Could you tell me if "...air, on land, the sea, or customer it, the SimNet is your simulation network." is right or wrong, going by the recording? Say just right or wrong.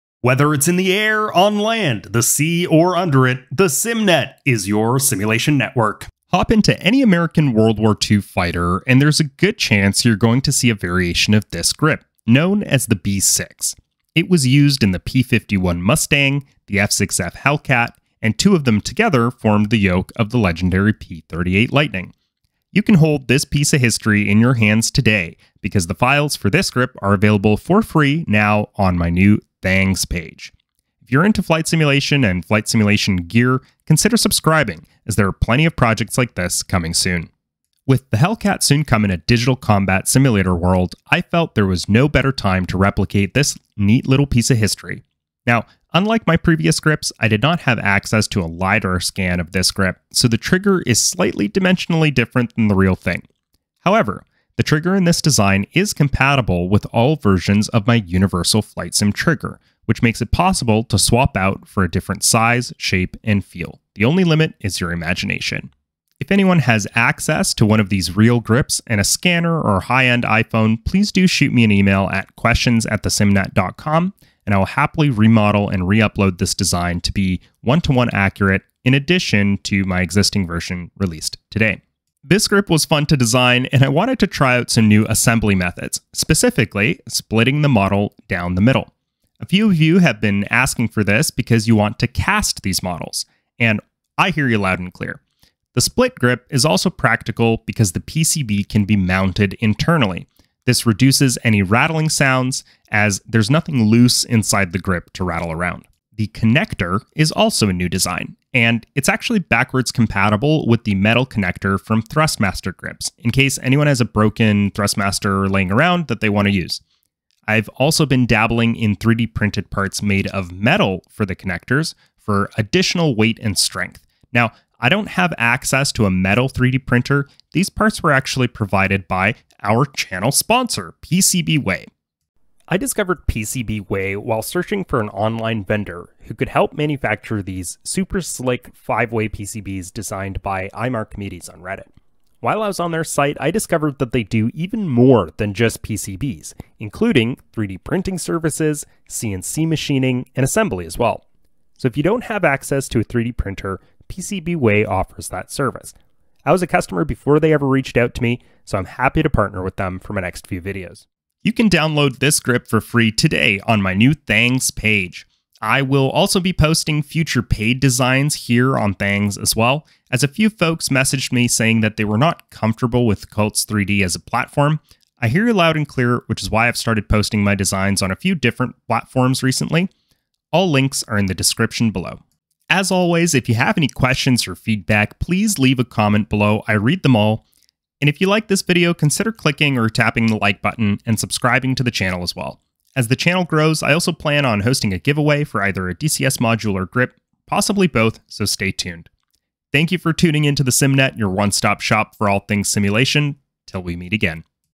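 wrong.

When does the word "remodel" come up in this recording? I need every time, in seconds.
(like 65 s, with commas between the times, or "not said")
75 s.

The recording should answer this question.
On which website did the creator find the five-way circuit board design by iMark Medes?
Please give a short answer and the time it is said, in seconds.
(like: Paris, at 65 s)
Reddit, at 141 s.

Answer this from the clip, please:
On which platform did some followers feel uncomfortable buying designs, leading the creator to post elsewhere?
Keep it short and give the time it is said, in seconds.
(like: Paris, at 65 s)
Cults 3D, at 173 s.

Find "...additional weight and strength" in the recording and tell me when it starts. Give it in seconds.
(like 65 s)
122 s.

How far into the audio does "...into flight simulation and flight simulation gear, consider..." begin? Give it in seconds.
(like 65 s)
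31 s.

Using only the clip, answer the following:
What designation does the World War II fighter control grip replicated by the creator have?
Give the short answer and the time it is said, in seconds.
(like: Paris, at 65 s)
B6, at 12 s.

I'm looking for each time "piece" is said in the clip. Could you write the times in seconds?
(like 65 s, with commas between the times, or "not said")
23 s, 44 s.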